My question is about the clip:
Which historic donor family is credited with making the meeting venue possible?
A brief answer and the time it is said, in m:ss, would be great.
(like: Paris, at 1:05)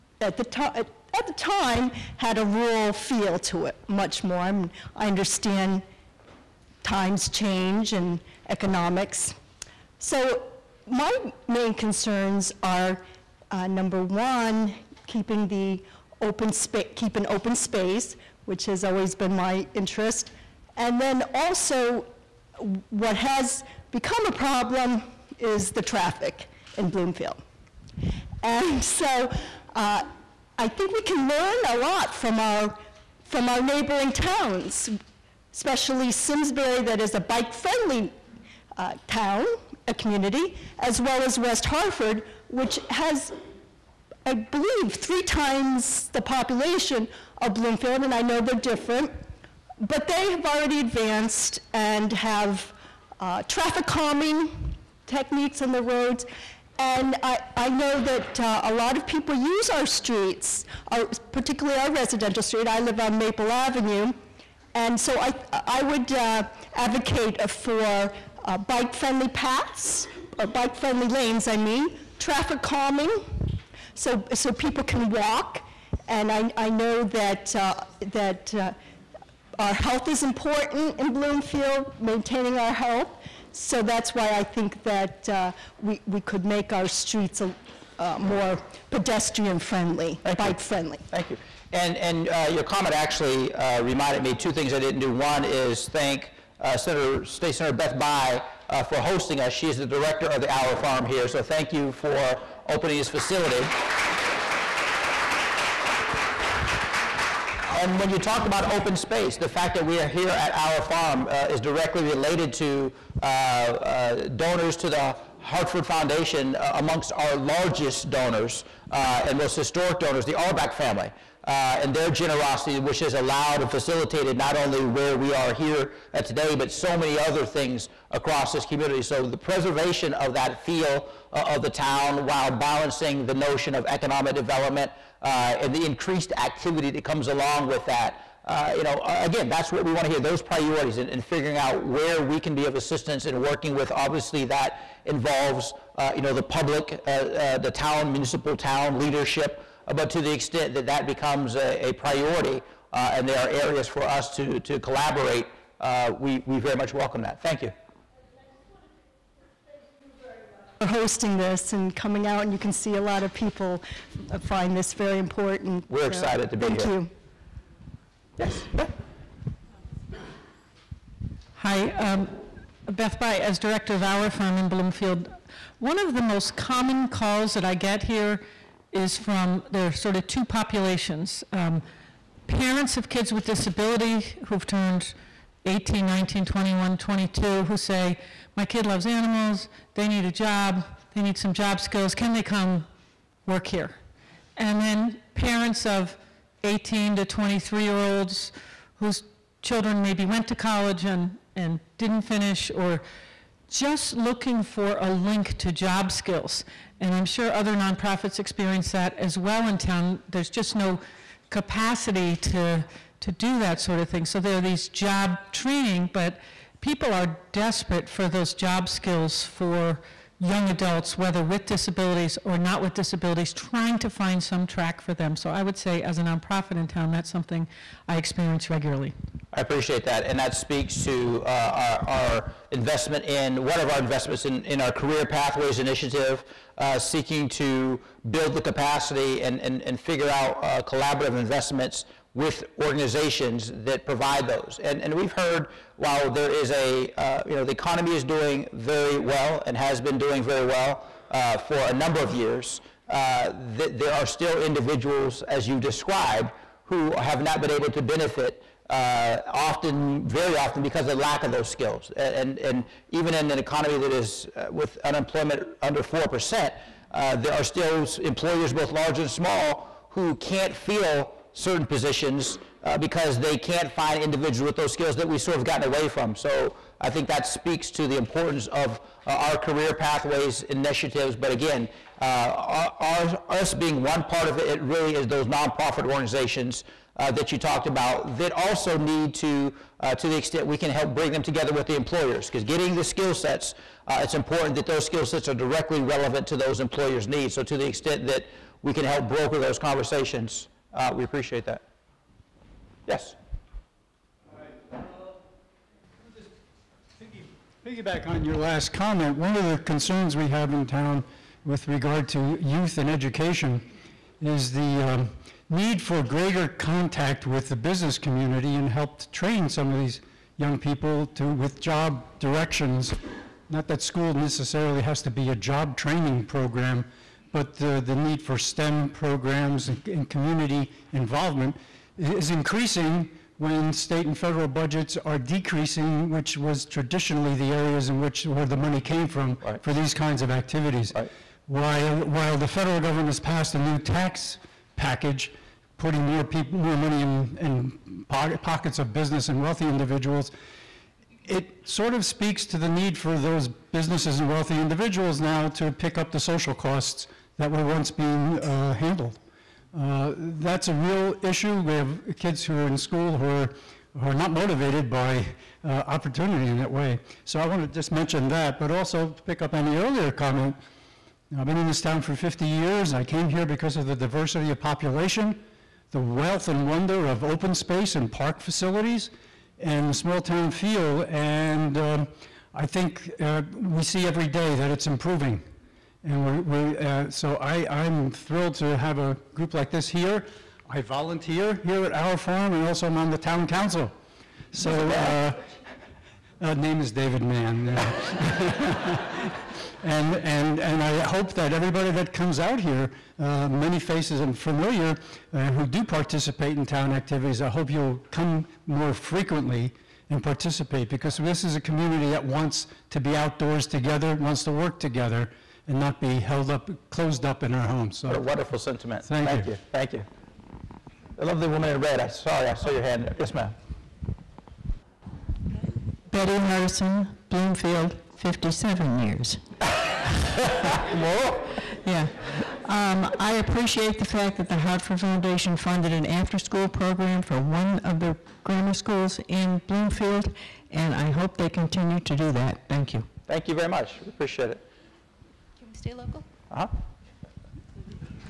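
Auerbach family, at 2:00.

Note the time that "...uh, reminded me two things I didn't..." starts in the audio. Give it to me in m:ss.
1:33.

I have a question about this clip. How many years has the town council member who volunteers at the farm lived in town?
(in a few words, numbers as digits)
50 years.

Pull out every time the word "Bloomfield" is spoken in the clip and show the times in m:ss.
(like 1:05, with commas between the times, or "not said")
0:26, 0:47, 1:21, 2:54, 7:07, 7:19.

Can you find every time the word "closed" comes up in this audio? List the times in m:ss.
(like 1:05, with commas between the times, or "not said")
6:57.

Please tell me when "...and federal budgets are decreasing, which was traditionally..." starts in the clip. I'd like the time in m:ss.
5:34.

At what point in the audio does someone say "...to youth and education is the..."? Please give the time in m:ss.
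5:12.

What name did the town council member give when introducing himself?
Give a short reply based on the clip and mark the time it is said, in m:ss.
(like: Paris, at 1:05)
David Mann, at 6:37.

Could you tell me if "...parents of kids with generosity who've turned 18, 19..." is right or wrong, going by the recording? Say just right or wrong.
wrong.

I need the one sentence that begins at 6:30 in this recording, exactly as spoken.
I volunteer here at Auer Farm, and also I'm on the town council.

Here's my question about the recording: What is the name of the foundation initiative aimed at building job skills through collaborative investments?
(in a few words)
Career Pathways Initiative.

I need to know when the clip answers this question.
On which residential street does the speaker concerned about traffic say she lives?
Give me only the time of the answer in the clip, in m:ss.
1:03.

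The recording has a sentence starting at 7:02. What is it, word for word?
I sorry, I saw your hand.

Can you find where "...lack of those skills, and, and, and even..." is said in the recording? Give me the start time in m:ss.
4:21.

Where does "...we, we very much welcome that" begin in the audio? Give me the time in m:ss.
2:36.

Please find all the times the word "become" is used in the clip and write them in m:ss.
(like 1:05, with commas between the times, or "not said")
0:23, 2:31.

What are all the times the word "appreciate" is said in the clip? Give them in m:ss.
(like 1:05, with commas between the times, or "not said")
3:49, 5:01, 7:13, 7:24.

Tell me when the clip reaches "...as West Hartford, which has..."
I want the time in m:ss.
0:41.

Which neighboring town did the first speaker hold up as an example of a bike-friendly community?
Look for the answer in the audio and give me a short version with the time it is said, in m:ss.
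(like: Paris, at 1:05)
Simsbury, at 0:36.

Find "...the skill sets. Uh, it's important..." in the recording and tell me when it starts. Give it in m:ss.
4:52.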